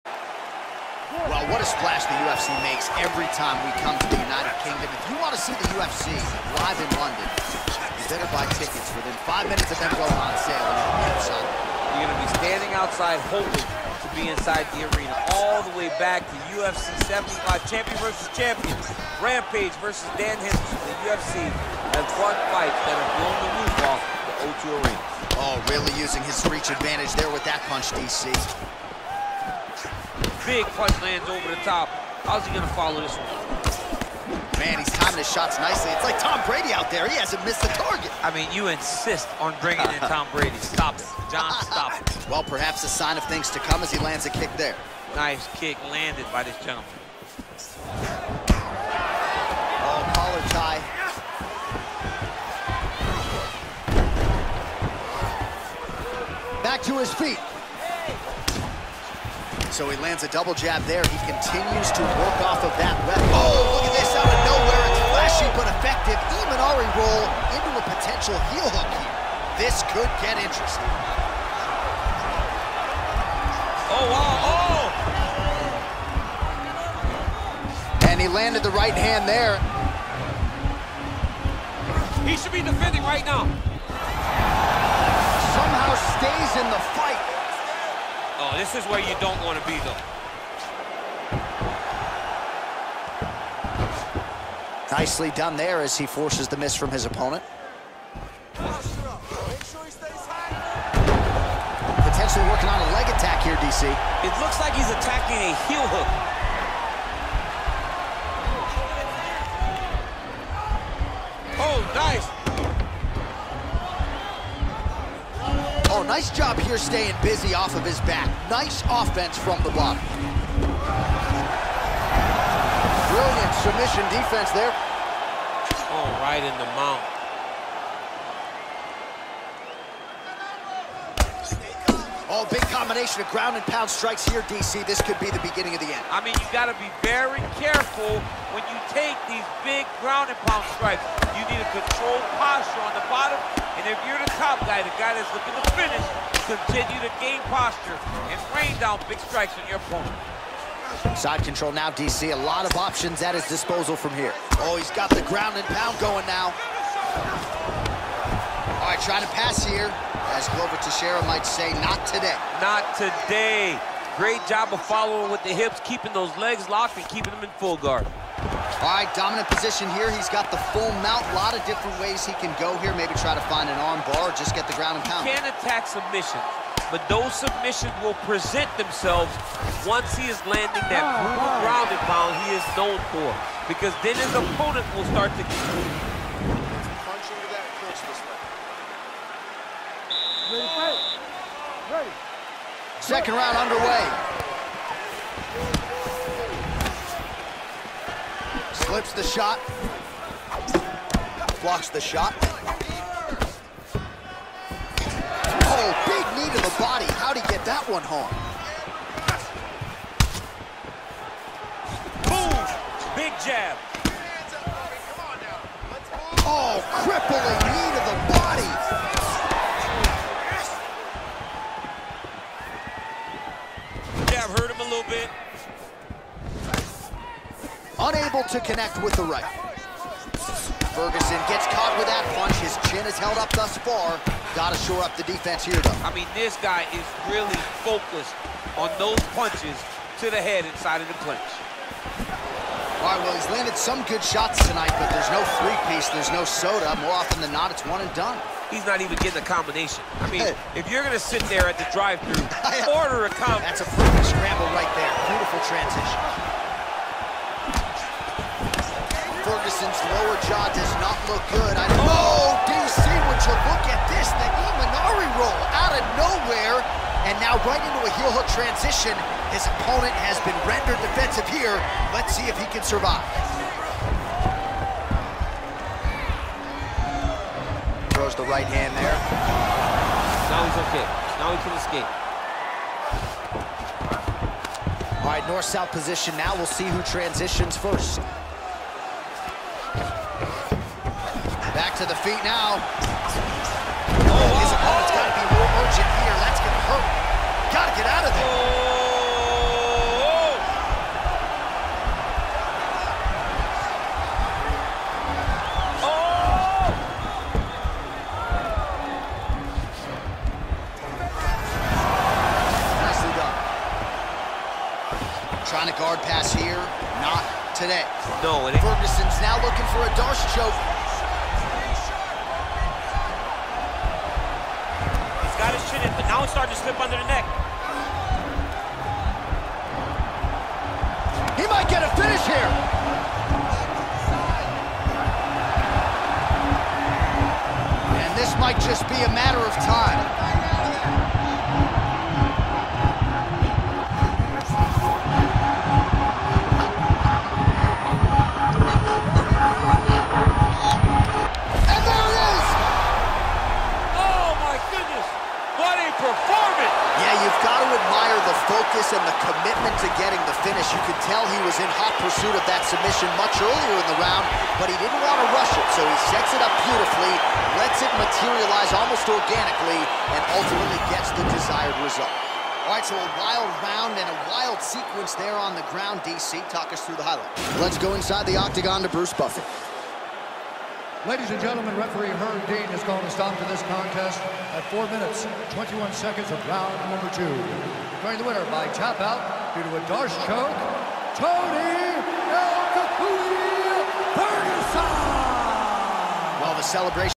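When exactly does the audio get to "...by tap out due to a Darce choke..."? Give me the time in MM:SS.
06:28.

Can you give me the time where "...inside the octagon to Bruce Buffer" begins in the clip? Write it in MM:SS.
06:18.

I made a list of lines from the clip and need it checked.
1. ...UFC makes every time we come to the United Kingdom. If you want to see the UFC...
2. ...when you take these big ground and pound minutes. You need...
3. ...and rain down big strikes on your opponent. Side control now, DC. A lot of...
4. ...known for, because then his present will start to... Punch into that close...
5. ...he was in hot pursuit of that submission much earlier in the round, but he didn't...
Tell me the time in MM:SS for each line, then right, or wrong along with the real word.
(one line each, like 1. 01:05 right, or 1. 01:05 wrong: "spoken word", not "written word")
1. 00:02 right
2. 02:18 wrong: "strikes", not "minutes"
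3. 02:28 right
4. 03:02 wrong: "opponent", not "present"
5. 06:01 right.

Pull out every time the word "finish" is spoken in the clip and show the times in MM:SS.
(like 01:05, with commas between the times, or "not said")
02:25, 05:32.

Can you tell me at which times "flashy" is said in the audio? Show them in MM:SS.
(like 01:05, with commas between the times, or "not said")
01:05.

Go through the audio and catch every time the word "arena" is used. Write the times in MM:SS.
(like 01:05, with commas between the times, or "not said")
00:14, 00:24.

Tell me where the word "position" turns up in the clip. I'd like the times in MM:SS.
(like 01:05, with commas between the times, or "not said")
02:49, 04:45.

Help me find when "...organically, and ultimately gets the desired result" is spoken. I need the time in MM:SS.
06:09.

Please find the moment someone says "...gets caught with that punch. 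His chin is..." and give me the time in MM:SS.
03:51.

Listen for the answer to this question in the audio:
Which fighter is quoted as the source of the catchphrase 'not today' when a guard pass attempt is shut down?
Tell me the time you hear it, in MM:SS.
02:40.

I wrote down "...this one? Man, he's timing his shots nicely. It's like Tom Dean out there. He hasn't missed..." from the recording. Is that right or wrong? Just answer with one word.
wrong.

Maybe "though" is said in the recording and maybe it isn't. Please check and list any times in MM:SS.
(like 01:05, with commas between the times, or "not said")
01:29, 03:55.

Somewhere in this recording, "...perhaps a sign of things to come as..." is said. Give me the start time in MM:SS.
00:42.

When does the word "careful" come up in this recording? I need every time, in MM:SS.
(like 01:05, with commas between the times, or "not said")
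02:17.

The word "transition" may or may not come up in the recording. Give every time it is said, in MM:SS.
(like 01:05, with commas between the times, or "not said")
04:15, 04:28, 04:47.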